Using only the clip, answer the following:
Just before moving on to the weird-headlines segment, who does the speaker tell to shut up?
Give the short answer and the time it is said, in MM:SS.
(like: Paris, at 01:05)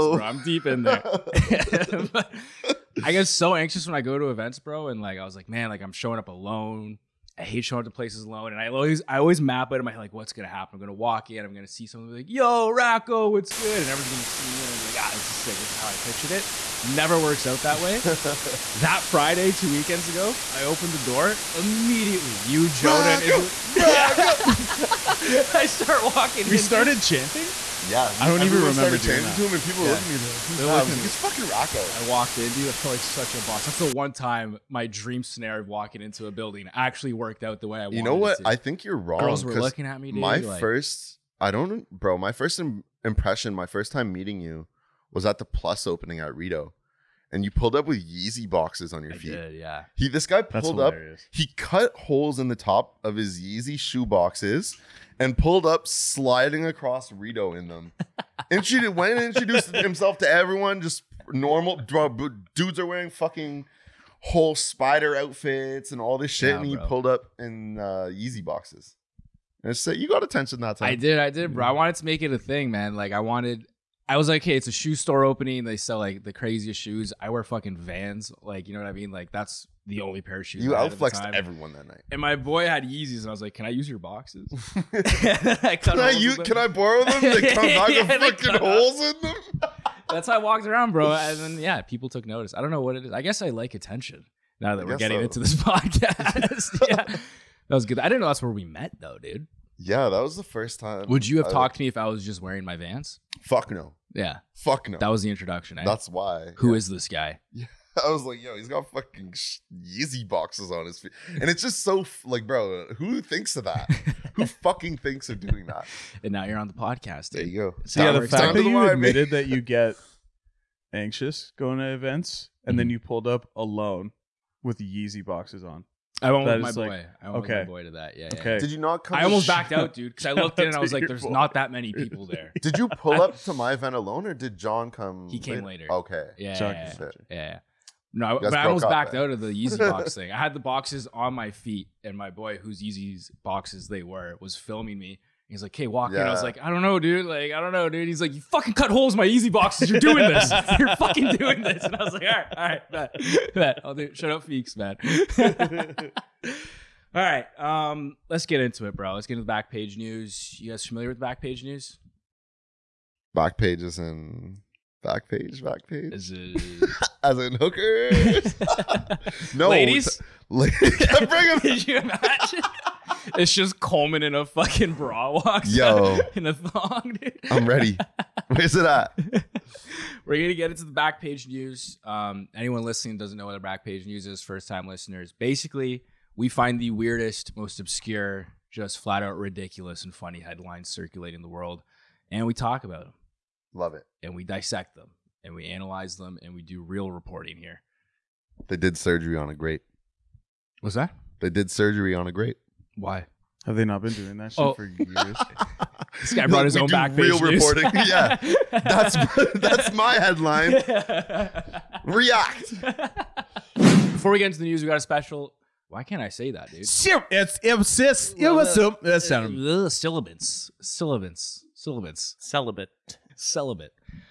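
Feeks, at 02:34.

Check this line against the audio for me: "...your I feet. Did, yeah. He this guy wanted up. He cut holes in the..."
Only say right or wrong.
wrong.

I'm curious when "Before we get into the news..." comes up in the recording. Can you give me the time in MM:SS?
03:34.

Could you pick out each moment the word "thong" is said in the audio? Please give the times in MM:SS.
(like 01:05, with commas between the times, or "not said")
02:56.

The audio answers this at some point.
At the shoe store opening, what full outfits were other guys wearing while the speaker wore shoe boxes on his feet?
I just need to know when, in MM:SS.
01:04.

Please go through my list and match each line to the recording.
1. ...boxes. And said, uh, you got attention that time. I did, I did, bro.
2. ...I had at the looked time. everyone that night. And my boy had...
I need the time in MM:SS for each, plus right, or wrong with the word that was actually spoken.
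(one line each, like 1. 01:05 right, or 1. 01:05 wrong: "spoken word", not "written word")
1. 01:08 right
2. 01:20 wrong: "outflexed", not "looked".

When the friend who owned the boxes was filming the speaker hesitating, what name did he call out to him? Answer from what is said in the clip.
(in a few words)
Walker.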